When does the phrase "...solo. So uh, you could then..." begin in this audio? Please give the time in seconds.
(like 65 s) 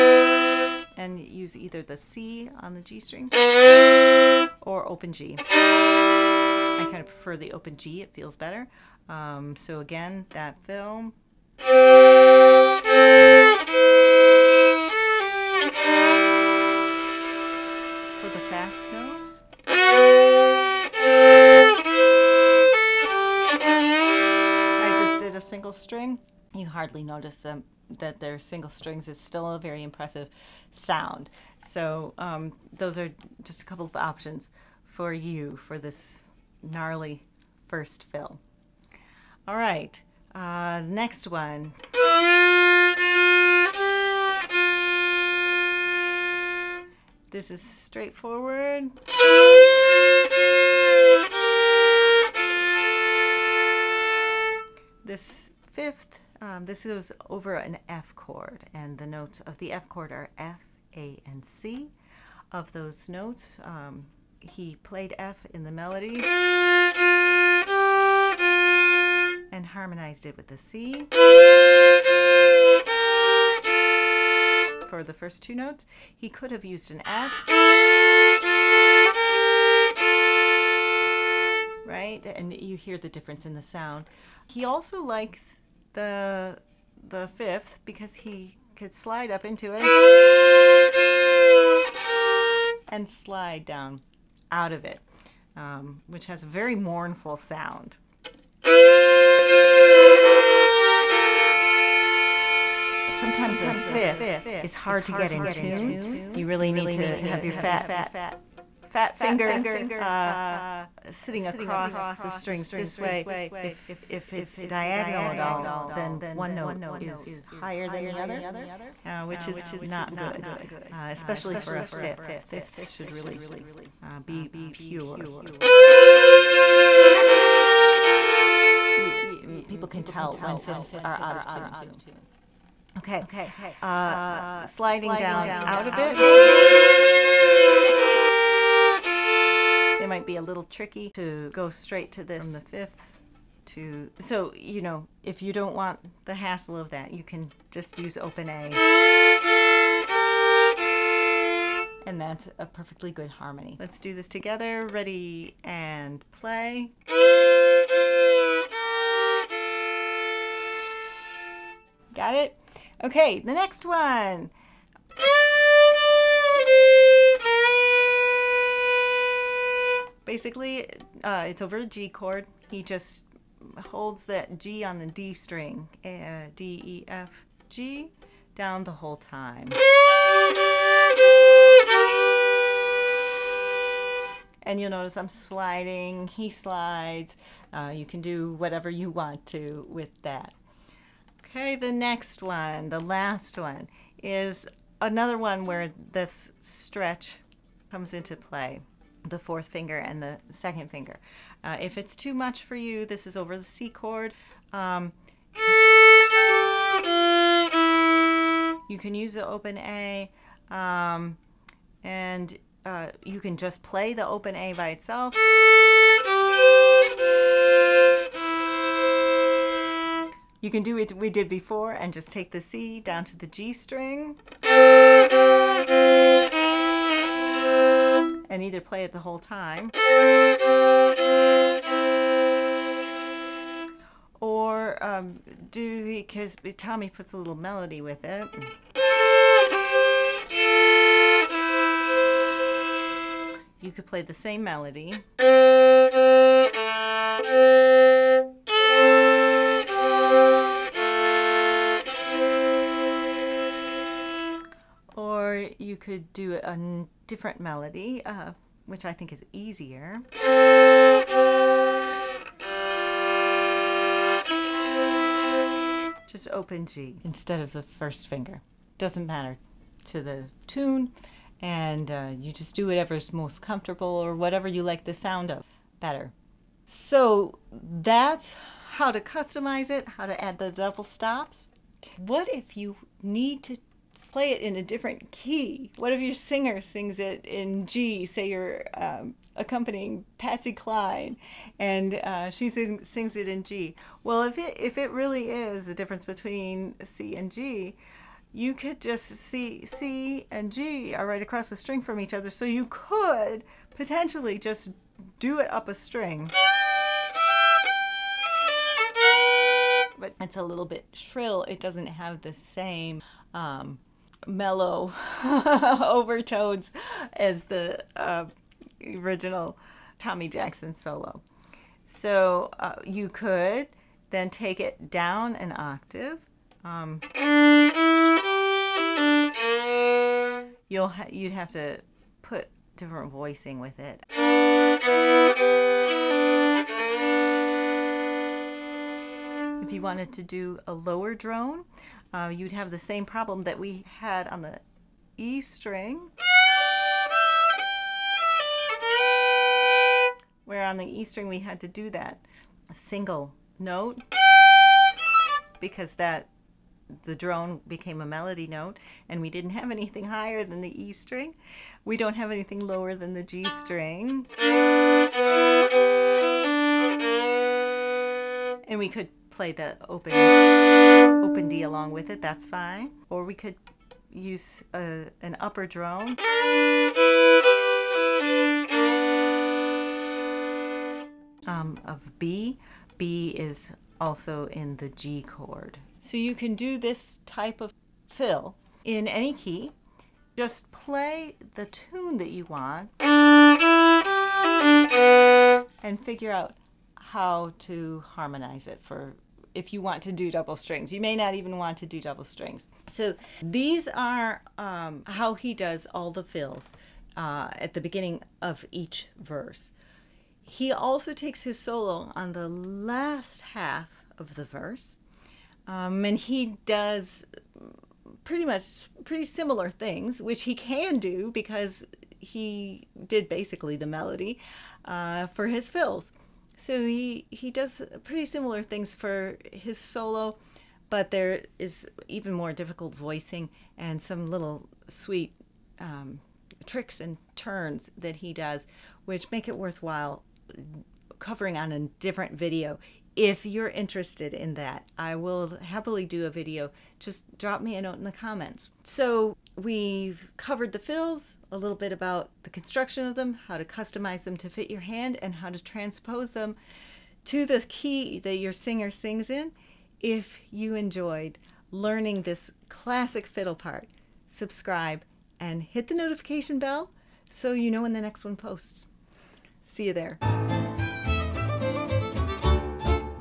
320 s.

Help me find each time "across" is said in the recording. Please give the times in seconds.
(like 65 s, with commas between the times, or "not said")
111 s, 301 s.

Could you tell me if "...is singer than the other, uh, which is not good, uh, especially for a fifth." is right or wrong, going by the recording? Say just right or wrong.
wrong.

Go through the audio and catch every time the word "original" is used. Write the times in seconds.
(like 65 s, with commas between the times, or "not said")
319 s.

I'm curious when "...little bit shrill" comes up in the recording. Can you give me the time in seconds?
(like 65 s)
310 s.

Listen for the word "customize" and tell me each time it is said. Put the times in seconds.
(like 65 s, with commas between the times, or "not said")
279 s, 453 s.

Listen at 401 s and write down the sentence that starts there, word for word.
You may not even want to do double strings.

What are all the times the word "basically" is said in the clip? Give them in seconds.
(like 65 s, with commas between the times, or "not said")
170 s, 423 s.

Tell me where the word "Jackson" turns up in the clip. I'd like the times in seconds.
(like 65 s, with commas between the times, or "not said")
320 s.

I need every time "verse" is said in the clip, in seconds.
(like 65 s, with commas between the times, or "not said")
409 s, 414 s.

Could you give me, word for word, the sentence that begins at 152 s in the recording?
And that's a perfectly good harmony.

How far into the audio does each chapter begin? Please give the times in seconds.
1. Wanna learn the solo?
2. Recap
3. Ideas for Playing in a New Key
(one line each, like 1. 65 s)
1. 404 s
2. 450 s
3. 281 s.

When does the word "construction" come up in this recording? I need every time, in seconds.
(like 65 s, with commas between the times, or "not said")
452 s.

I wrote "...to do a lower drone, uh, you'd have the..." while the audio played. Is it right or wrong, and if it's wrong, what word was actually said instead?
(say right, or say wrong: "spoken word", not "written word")
right.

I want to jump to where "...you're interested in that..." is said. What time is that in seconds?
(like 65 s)
443 s.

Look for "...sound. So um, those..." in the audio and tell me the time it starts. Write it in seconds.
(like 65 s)
30 s.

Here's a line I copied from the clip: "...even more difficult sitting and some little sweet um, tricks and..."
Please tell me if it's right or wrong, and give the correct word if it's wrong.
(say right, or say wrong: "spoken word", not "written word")
wrong: "voicing", not "sitting".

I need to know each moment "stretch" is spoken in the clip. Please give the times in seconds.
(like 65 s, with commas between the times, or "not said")
196 s.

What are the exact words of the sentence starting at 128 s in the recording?
Mm, people can tell when fifths are out of tune.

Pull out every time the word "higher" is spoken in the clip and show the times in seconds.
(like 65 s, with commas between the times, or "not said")
117 s, 360 s.